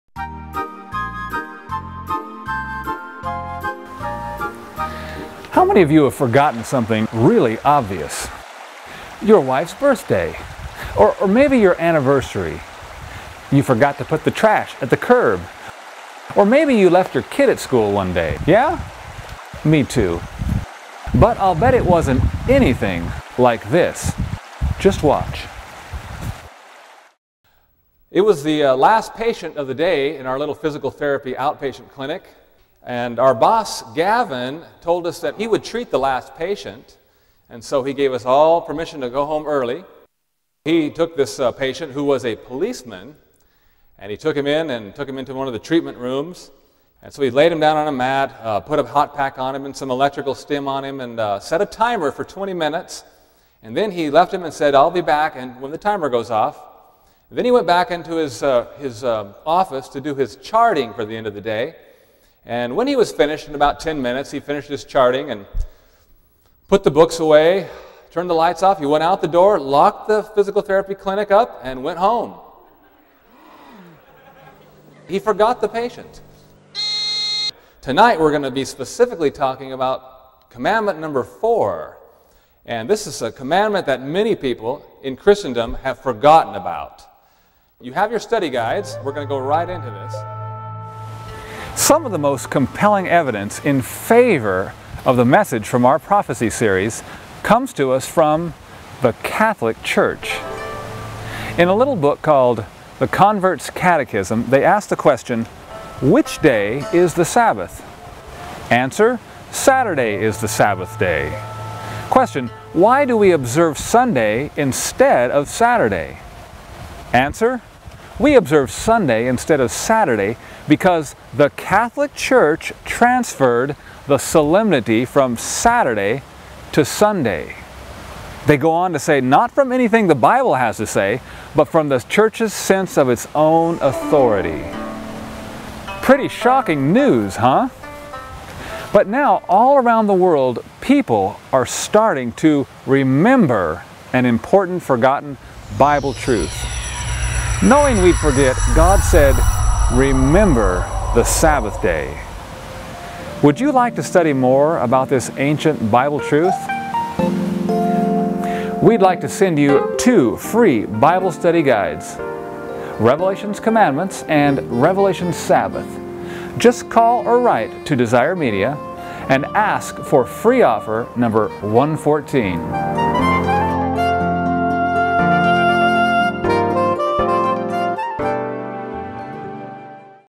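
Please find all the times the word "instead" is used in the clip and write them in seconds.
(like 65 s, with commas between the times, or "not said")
114 s, 119 s.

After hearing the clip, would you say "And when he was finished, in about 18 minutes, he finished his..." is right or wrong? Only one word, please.
wrong.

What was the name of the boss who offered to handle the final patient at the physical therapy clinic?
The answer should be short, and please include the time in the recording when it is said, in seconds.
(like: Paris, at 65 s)
Gavin, at 33 s.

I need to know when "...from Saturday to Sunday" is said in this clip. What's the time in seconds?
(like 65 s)
125 s.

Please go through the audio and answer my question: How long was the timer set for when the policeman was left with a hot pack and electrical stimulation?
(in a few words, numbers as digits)
20 minutes.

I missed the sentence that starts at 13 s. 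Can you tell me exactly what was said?
You forgot to put the trash at the curb, or maybe you left your kid at school one day.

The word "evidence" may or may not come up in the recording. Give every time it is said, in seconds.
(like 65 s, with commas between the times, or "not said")
93 s.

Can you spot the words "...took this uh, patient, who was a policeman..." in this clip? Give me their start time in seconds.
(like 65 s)
40 s.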